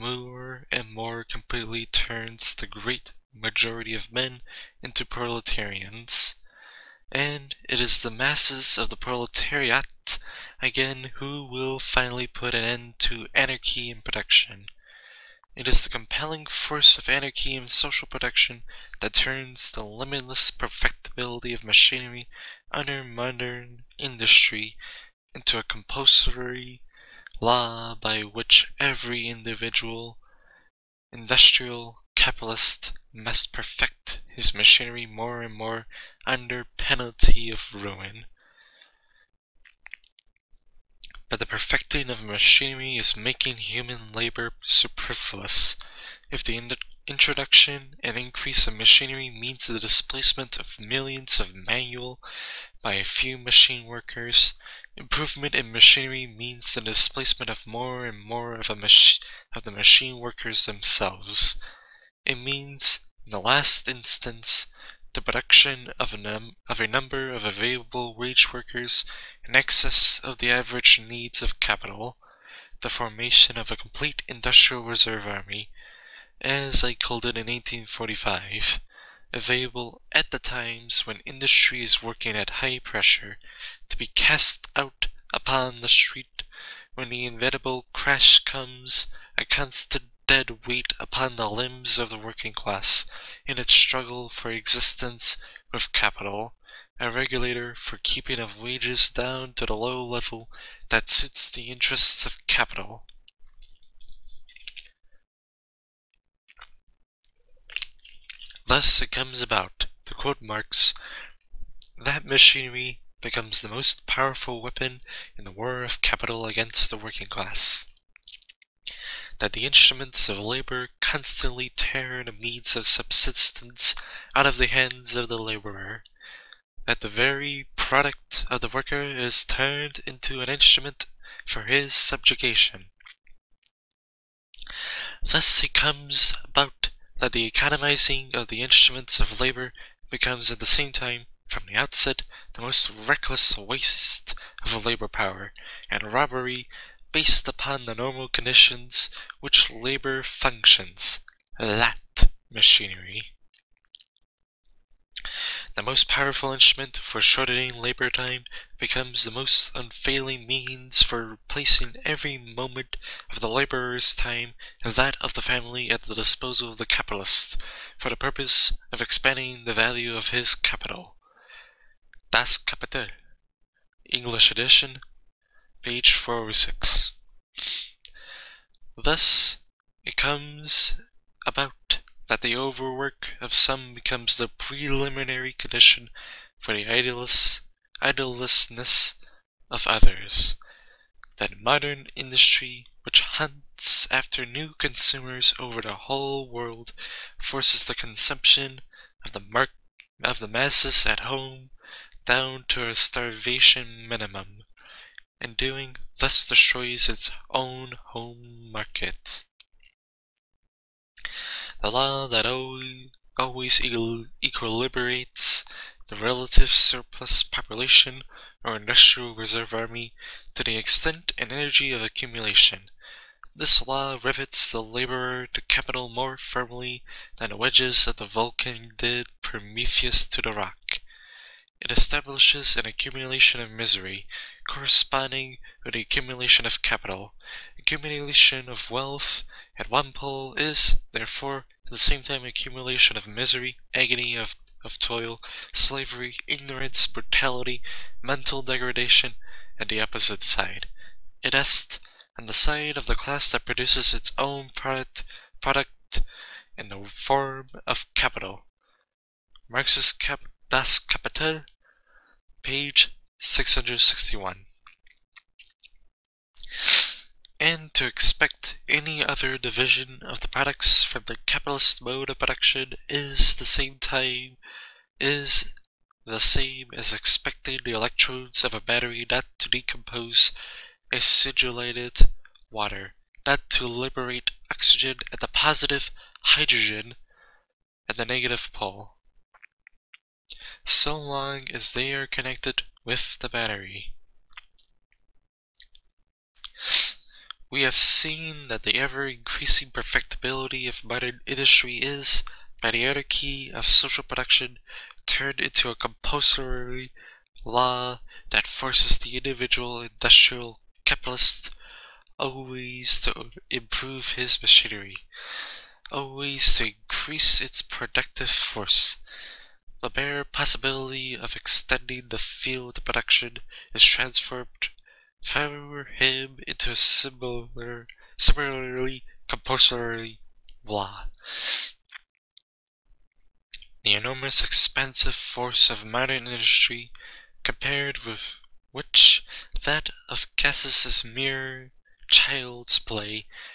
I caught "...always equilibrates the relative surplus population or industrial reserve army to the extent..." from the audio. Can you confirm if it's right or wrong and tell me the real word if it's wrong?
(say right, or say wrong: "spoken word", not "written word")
right.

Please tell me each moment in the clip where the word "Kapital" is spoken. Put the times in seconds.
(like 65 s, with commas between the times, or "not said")
172 s, 260 s.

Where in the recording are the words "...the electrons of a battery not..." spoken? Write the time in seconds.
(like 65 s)
277 s.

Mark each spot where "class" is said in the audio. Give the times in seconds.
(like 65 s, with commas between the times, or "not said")
92 s, 117 s, 253 s.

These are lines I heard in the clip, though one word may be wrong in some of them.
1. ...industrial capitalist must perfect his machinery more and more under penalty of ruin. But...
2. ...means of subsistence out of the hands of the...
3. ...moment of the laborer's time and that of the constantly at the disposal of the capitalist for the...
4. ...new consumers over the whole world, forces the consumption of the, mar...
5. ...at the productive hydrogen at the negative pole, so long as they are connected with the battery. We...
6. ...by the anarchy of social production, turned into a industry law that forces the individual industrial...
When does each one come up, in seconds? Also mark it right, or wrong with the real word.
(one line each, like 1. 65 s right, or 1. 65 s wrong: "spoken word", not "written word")
1. 31 s right
2. 122 s right
3. 162 s wrong: "family", not "constantly"
4. 194 s right
5. 285 s wrong: "positive", not "productive"
6. 302 s wrong: "compulsory", not "industry".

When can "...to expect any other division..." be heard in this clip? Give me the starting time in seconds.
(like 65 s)
267 s.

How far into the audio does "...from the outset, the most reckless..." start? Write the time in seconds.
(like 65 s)
141 s.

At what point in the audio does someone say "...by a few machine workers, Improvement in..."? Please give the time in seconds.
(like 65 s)
52 s.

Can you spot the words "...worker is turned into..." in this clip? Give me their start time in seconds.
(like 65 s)
128 s.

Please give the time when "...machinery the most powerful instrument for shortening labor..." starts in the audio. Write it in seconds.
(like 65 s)
152 s.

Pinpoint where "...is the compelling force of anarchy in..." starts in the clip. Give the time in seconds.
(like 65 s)
15 s.